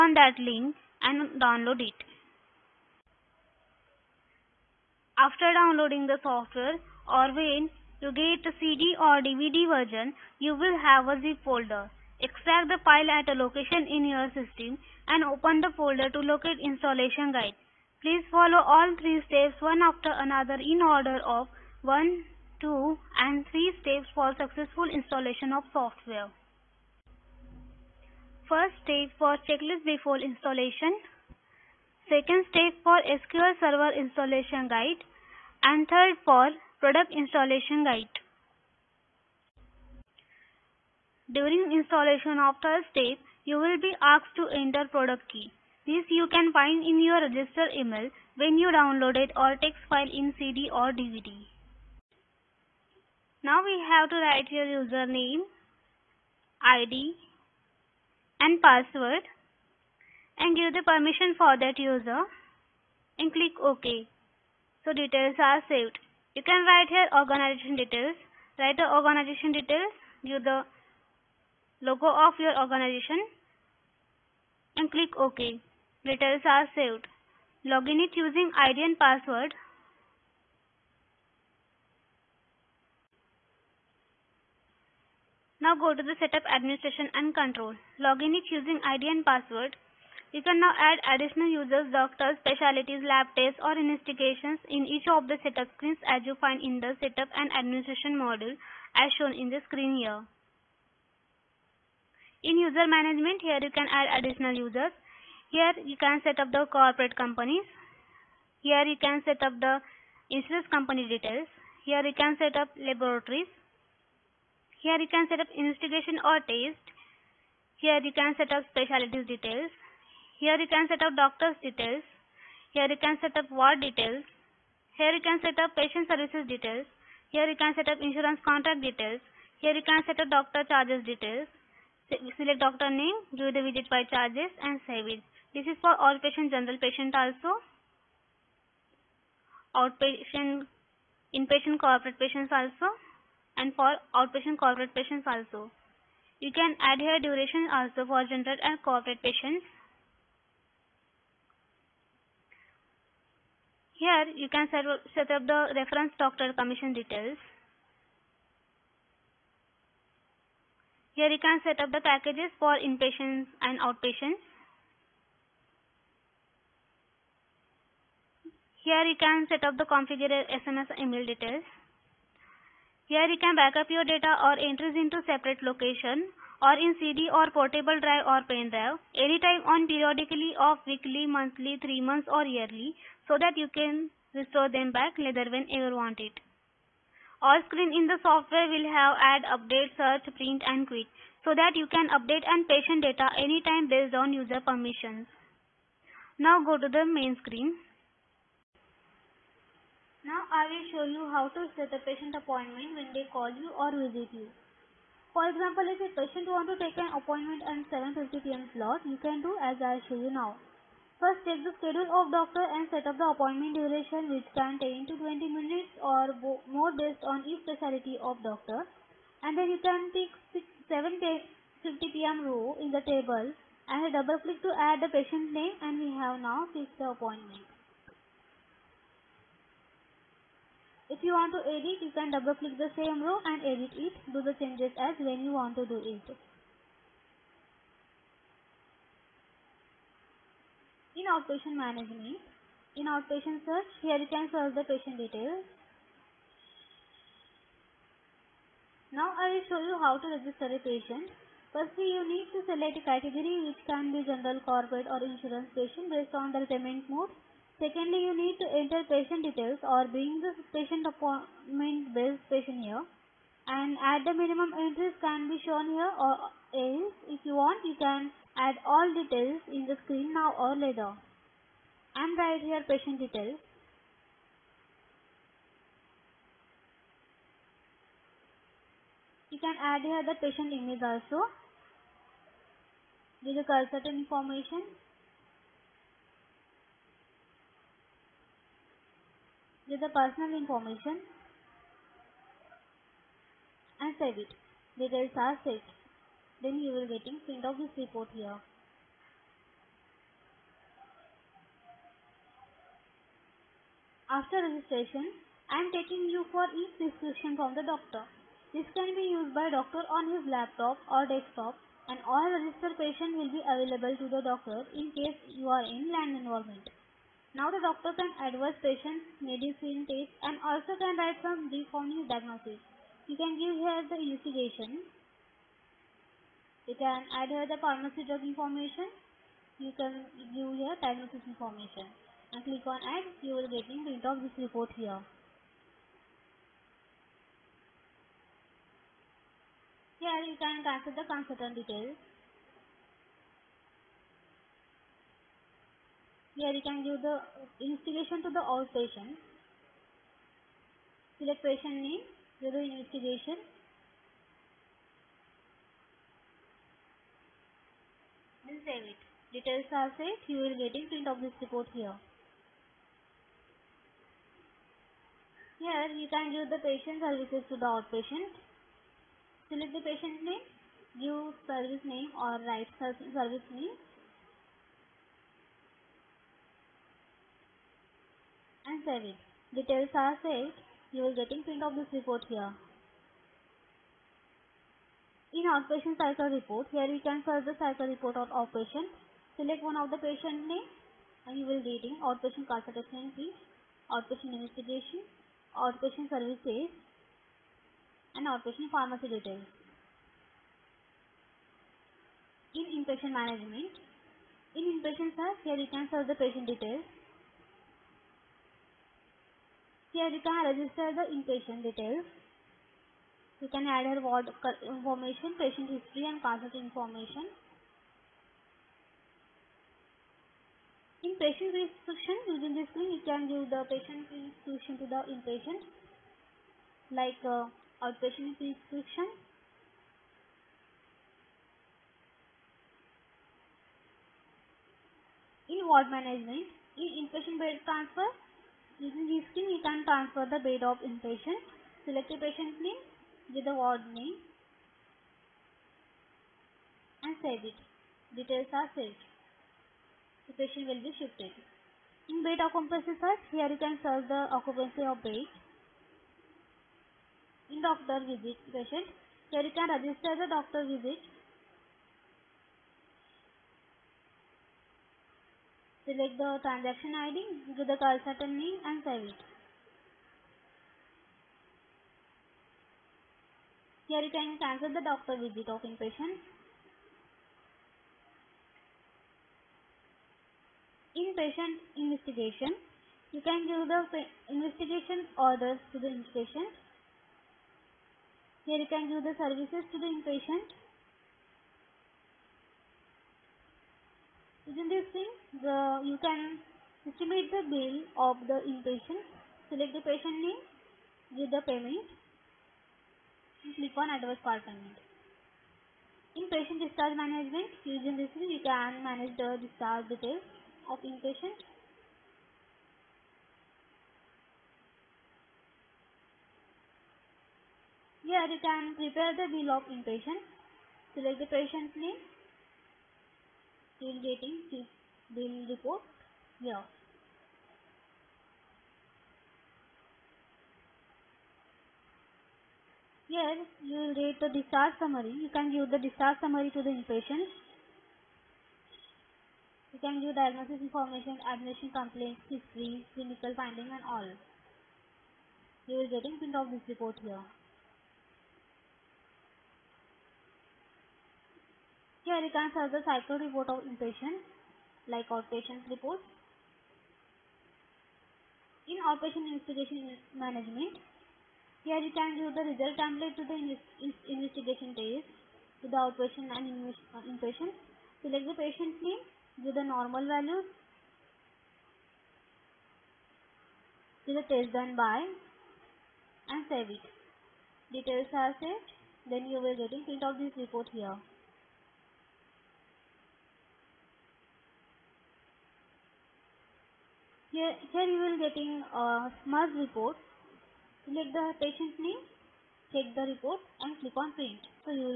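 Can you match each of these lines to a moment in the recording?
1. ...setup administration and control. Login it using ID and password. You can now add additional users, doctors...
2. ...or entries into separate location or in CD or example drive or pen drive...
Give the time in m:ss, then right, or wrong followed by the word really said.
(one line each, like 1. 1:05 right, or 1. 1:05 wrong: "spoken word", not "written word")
1. 1:26 right
2. 2:54 wrong: "portable", not "example".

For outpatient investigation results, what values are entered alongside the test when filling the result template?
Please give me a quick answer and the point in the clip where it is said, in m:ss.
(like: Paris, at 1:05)
normal values, at 9:29.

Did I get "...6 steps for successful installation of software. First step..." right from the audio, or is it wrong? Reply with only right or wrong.
wrong.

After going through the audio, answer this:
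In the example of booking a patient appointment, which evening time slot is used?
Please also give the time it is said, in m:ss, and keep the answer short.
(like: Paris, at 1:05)
7:50 pm, at 3:27.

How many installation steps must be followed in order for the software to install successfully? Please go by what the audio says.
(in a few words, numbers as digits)
3.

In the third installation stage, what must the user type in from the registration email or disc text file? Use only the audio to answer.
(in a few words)
product key.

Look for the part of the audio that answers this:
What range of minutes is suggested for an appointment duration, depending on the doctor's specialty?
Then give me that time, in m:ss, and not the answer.
3:34.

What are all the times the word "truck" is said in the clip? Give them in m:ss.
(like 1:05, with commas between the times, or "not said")
not said.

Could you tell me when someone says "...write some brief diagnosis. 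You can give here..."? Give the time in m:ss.
5:21.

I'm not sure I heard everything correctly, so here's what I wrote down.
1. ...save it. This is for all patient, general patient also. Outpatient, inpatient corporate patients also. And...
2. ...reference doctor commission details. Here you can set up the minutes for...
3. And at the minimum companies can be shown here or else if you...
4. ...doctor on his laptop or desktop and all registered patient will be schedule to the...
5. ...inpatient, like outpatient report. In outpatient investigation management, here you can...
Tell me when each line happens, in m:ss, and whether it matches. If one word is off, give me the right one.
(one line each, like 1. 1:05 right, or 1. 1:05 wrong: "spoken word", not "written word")
1. 2:14 right
2. 2:35 wrong: "packages", not "minutes"
3. 4:23 wrong: "entries", not "companies"
4. 5:09 wrong: "available", not "schedule"
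5. 9:13 right.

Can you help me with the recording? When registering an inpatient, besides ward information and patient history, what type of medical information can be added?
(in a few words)
cardiac information.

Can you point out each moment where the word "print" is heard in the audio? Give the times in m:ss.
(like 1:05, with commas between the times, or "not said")
3:10, 4:57, 5:34, 6:01, 6:21, 9:06, 9:40, 9:54.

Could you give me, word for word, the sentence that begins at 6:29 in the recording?
Select one of the patient name and you will reading outpatient consultation fee, outpatient investigation, outpatient services and outpatient pharmacy details.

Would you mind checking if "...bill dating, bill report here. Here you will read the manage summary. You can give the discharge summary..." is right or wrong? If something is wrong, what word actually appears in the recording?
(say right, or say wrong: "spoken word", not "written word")
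wrong: "discharge", not "manage".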